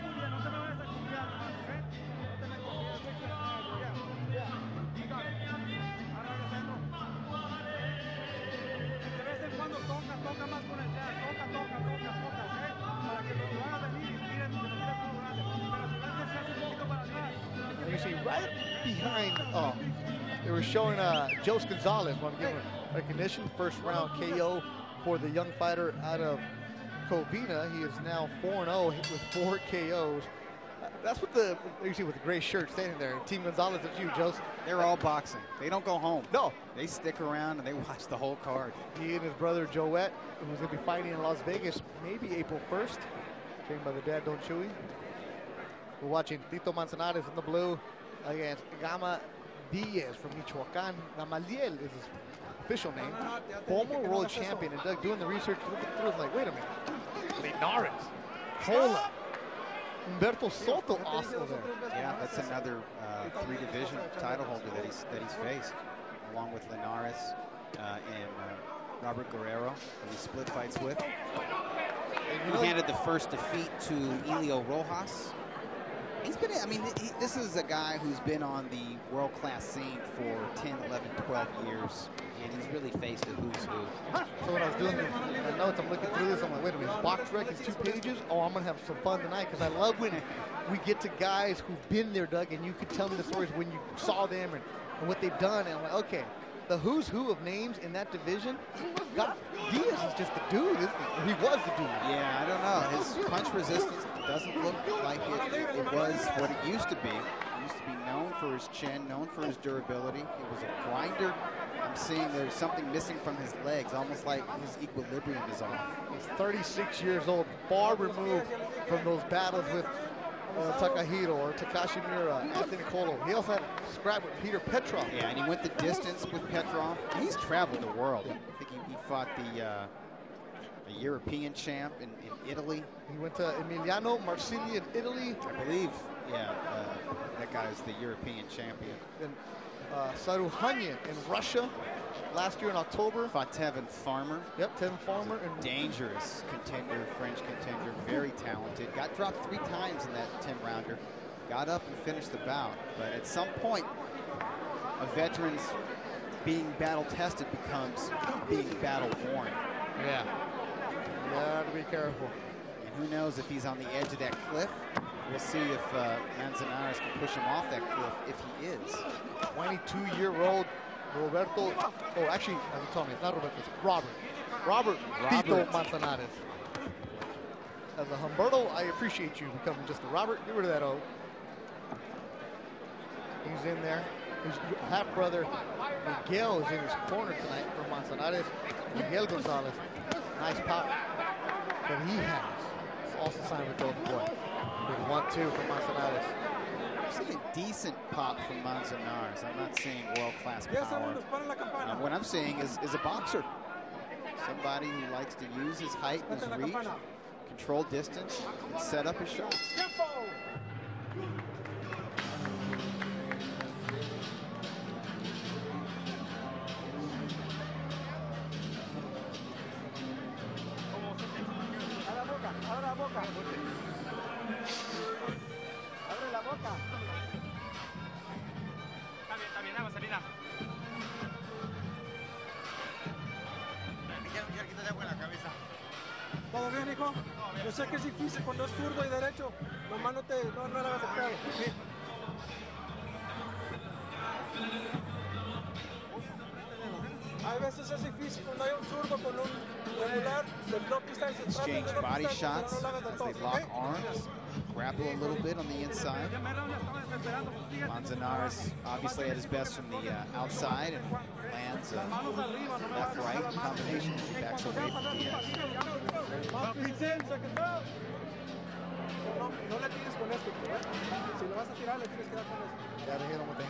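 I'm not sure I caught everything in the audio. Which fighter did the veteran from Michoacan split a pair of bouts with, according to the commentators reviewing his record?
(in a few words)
Robert Guerrero.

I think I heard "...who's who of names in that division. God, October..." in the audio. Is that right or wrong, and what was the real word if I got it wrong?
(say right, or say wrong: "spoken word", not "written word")
wrong: "Diaz", not "October".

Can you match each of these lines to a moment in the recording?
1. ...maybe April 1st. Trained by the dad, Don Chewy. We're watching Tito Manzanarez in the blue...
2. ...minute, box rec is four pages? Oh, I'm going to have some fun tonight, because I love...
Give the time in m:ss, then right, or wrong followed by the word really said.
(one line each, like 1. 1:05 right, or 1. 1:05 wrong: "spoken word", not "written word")
1. 0:42 right
2. 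1:26 wrong: "two", not "four".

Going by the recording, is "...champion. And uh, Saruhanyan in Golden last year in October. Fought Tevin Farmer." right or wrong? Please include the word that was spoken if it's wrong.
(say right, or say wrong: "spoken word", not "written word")
wrong: "Russia", not "Golden".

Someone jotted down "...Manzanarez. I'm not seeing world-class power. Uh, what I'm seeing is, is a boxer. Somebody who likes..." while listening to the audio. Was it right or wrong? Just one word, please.
right.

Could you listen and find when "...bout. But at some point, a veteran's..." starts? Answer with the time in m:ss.
2:32.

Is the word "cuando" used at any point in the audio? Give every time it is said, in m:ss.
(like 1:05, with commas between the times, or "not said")
3:58, 4:08.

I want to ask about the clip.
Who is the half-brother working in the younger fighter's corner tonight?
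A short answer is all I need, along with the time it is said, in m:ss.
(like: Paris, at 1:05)
Miguel Gonzalez, at 3:08.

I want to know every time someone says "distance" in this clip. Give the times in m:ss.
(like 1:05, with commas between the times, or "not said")
2:05, 3:27.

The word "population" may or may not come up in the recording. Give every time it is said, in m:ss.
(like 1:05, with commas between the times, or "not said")
not said.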